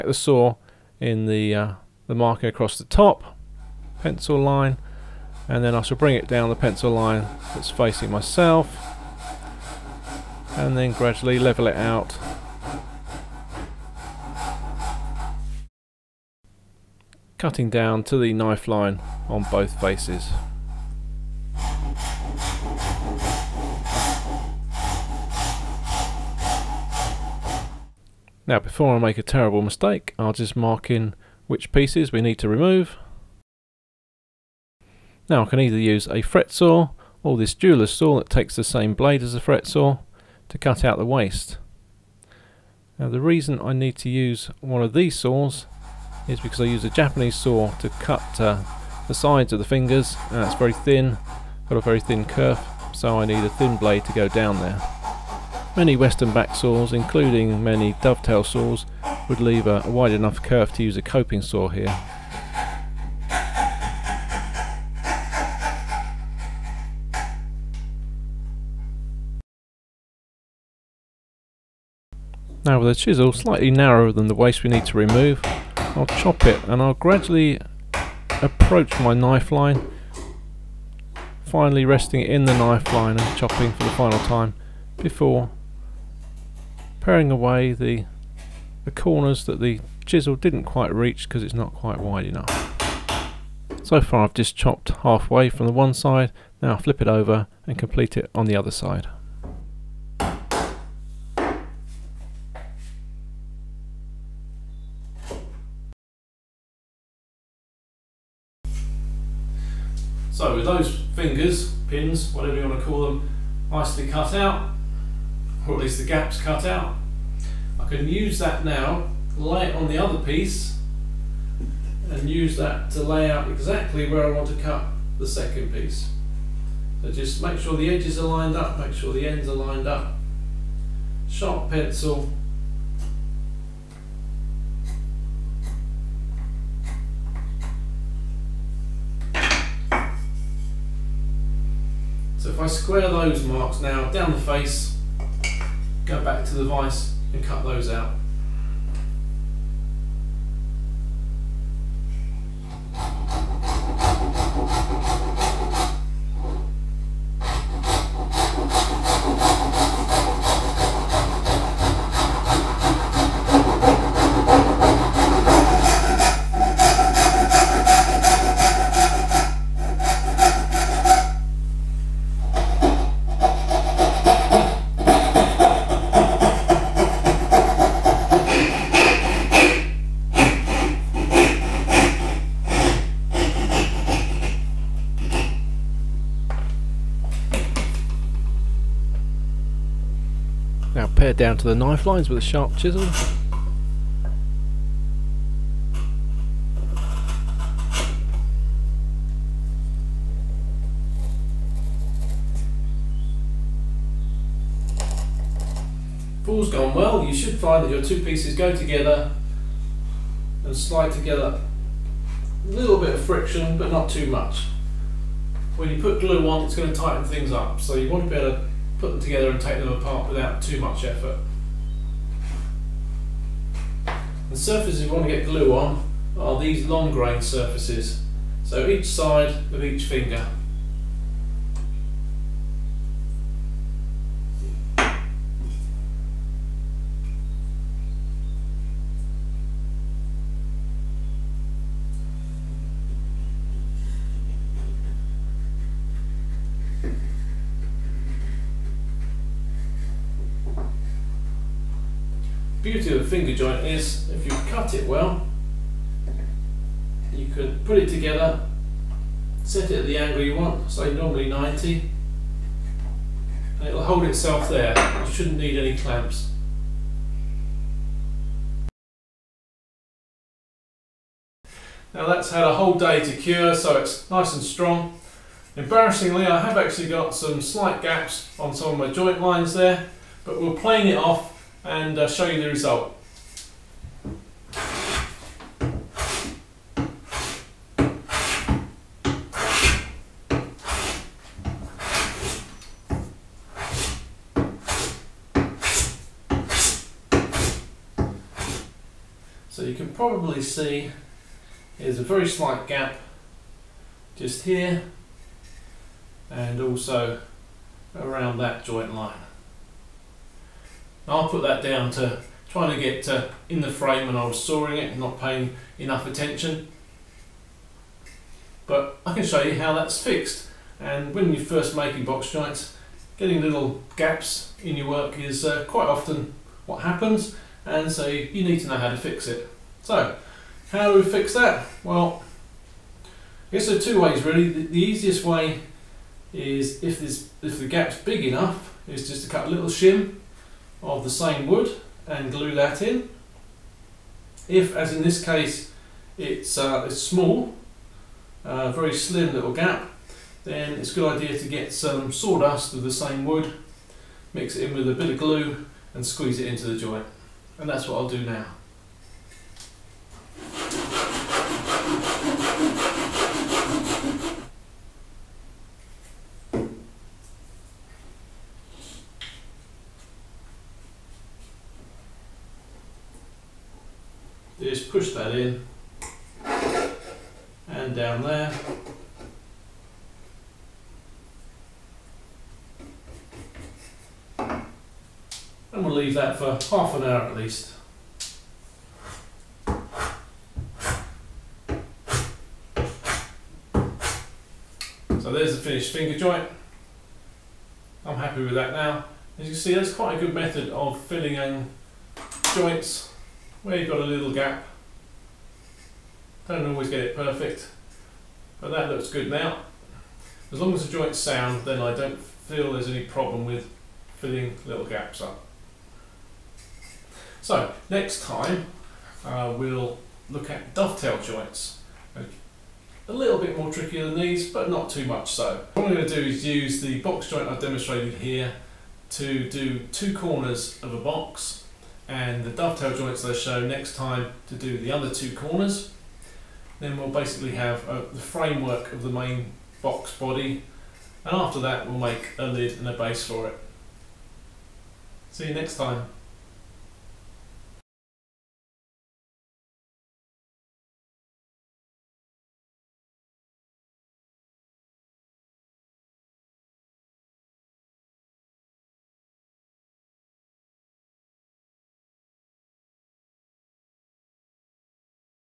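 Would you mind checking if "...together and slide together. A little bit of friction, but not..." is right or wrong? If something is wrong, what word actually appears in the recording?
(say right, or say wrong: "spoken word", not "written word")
right.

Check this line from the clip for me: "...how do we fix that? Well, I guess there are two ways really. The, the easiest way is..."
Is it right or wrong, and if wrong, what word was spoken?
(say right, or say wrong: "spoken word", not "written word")
right.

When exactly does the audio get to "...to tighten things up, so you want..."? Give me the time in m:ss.
3:36.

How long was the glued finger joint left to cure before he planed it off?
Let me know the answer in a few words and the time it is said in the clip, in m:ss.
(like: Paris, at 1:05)
a whole day, at 4:32.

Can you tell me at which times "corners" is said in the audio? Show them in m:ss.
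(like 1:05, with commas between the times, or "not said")
1:28, 7:10, 7:15.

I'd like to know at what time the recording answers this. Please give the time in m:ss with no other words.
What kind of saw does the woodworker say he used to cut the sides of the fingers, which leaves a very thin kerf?
0:46.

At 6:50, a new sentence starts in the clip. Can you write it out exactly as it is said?
As long as the joint's sound, then I don't feel there's any problem with filling little gaps up.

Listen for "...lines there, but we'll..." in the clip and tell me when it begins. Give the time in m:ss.
4:39.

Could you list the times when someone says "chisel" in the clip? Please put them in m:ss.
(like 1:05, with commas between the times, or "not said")
1:12, 1:30, 3:12.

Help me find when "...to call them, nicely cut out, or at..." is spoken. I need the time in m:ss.
1:52.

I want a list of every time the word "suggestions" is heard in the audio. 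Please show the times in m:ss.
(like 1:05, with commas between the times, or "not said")
not said.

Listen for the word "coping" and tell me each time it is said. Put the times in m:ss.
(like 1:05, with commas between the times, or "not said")
1:01.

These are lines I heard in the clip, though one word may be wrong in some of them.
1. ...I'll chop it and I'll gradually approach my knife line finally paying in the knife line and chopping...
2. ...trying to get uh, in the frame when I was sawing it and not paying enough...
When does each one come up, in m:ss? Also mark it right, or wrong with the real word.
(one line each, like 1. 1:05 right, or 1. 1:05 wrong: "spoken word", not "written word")
1. 1:15 wrong: "resting", not "paying"
2. 5:12 right.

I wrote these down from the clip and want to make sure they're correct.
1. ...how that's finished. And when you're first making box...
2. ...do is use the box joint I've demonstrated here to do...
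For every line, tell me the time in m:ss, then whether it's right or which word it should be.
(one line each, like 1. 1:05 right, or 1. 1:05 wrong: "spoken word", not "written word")
1. 5:19 wrong: "fixed", not "finished"
2. 7:06 right.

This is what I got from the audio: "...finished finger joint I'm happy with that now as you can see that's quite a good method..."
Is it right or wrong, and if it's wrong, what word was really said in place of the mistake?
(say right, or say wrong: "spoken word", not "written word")
right.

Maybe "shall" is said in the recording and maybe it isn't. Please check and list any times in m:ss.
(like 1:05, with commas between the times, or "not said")
0:05.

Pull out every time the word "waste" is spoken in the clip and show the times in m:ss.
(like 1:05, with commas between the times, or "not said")
0:41, 1:14.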